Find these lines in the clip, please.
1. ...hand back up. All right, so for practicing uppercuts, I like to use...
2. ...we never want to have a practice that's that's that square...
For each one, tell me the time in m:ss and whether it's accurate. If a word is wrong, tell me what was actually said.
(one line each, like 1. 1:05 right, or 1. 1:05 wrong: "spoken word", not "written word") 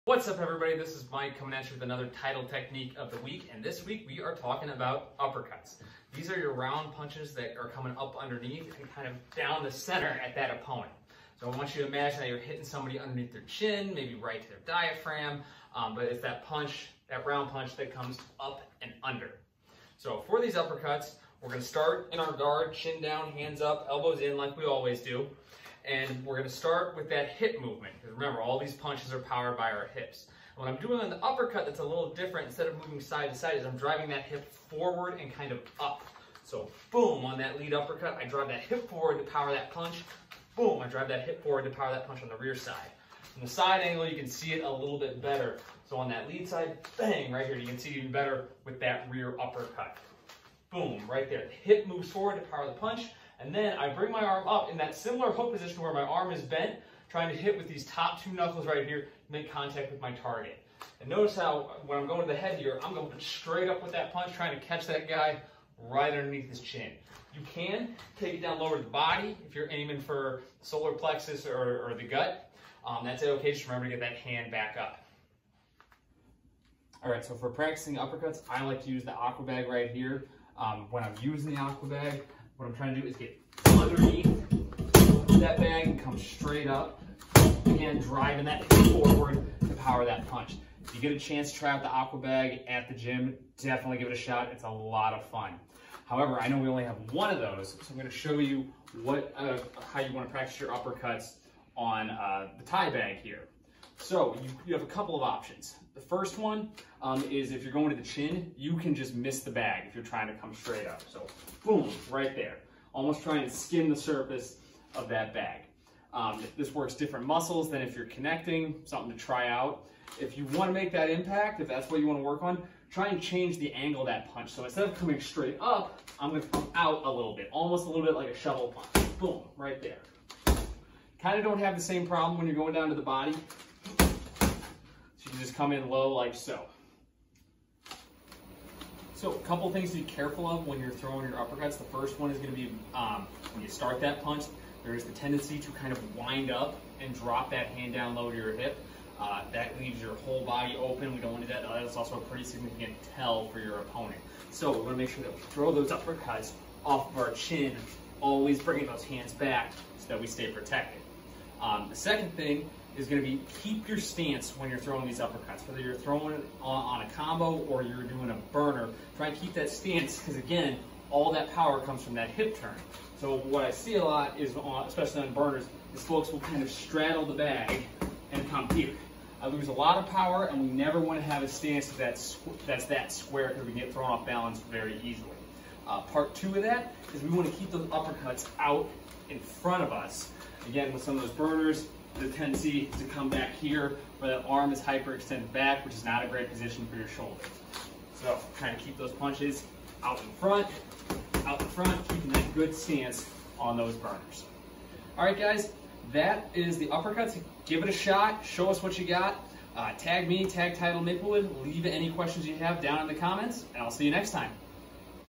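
1. 1:14 right
2. 3:00 wrong: "stance", not "practice".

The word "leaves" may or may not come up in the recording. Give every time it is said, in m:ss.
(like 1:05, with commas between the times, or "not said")
2:29, 3:31.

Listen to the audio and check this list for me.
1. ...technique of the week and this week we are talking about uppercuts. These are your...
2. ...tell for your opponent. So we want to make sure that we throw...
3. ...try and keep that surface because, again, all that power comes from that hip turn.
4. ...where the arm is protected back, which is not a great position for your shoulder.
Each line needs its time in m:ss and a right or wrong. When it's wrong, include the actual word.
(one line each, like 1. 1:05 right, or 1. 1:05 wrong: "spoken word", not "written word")
1. 0:02 right
2. 2:33 right
3. 2:49 wrong: "stance", not "surface"
4. 3:14 wrong: "hyperextended", not "protected".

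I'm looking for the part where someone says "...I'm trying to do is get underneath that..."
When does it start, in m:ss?
1:22.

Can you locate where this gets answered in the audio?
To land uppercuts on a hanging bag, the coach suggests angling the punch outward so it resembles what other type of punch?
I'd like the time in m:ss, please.
2:08.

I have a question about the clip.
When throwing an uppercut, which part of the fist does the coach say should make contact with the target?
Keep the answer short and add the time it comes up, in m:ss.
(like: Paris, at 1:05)
top two knuckles, at 0:57.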